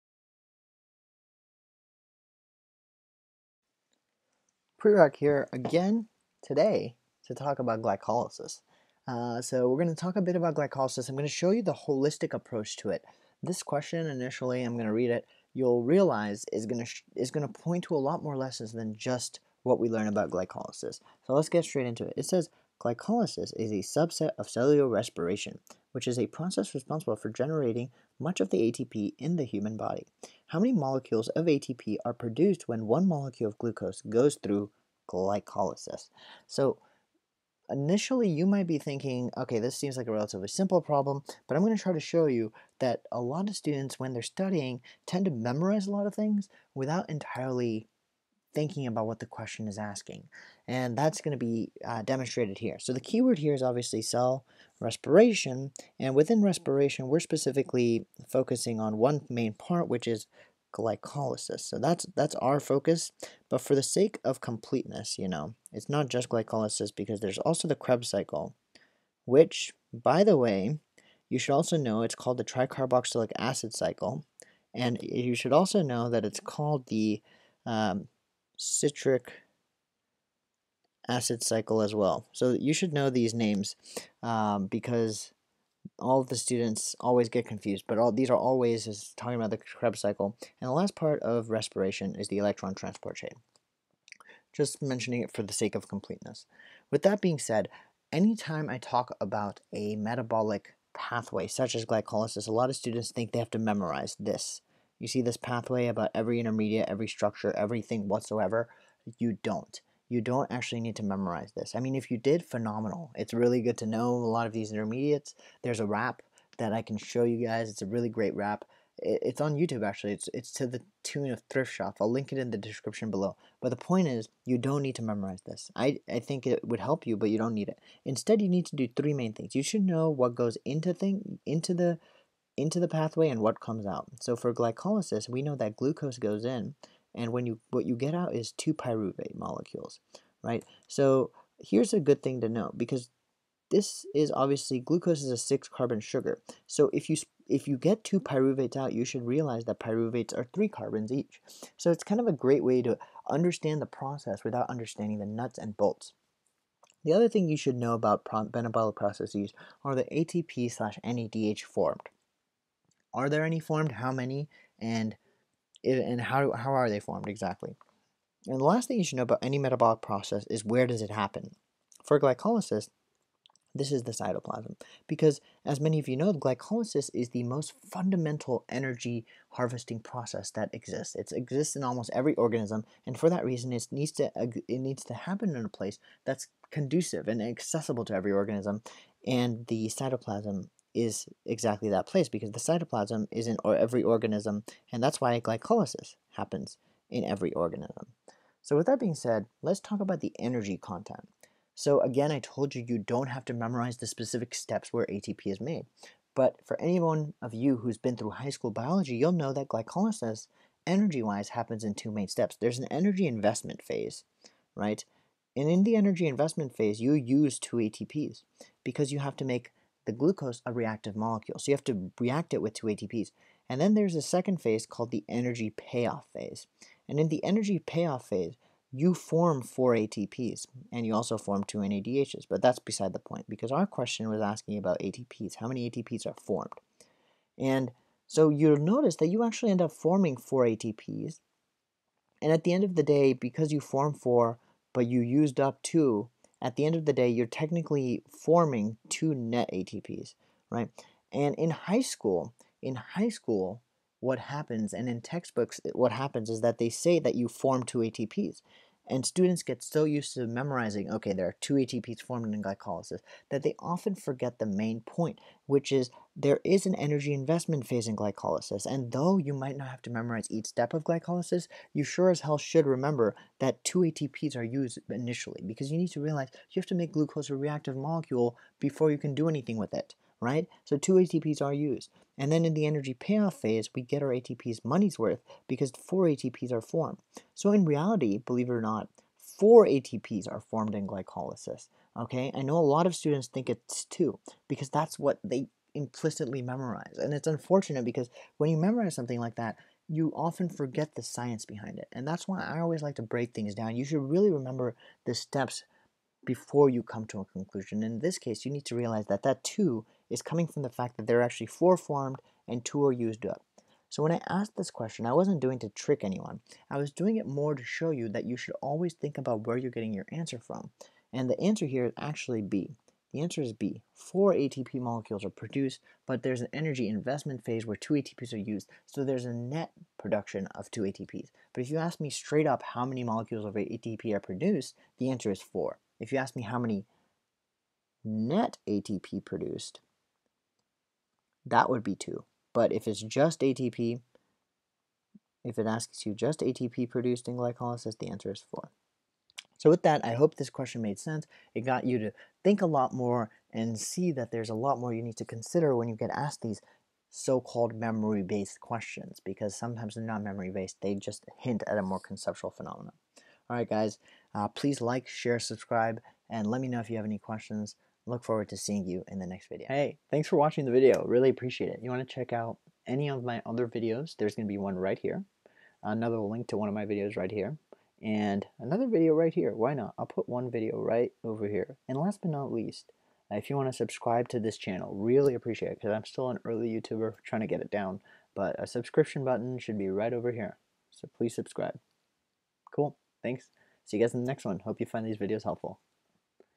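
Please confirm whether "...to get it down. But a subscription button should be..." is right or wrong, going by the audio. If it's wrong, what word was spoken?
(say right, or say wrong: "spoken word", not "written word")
right.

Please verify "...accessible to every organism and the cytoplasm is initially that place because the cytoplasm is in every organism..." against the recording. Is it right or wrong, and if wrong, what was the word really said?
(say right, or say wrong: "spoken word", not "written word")
wrong: "exactly", not "initially".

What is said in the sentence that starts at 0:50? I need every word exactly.
And that's going to be uh, demonstrated here.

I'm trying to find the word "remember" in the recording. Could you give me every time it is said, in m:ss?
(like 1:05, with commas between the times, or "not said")
4:32, 5:04.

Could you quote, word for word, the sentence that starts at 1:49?
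You don't you don't actually need to memorize this.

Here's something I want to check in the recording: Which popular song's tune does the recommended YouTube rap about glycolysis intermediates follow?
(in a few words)
Thrift Shop.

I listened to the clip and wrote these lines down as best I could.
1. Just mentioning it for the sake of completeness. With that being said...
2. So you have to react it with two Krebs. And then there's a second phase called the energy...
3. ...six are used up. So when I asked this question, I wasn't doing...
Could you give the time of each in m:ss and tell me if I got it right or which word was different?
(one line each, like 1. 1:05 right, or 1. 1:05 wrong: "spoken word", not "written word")
1. 1:34 right
2. 3:41 wrong: "ATPs", not "Krebs"
3. 5:12 wrong: "two", not "six".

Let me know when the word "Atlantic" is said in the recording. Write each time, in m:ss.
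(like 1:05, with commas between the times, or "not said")
not said.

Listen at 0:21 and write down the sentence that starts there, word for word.
So let's get straight into it.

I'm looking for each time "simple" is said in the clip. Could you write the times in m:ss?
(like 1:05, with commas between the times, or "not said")
0:40.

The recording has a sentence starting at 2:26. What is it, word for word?
So if you if you get two pyruvates out, you should realize that pyruvates are three carbons each.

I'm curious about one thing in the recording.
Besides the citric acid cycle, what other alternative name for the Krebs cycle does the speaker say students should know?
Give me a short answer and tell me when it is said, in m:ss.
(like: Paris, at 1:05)
tricarboxylic acid cycle, at 1:12.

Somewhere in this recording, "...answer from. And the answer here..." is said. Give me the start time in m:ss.
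5:20.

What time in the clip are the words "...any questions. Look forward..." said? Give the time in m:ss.
6:07.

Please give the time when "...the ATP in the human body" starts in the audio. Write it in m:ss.
0:28.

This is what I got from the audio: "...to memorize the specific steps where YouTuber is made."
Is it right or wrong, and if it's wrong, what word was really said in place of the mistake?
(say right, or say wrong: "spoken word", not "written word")
wrong: "ATP", not "YouTuber".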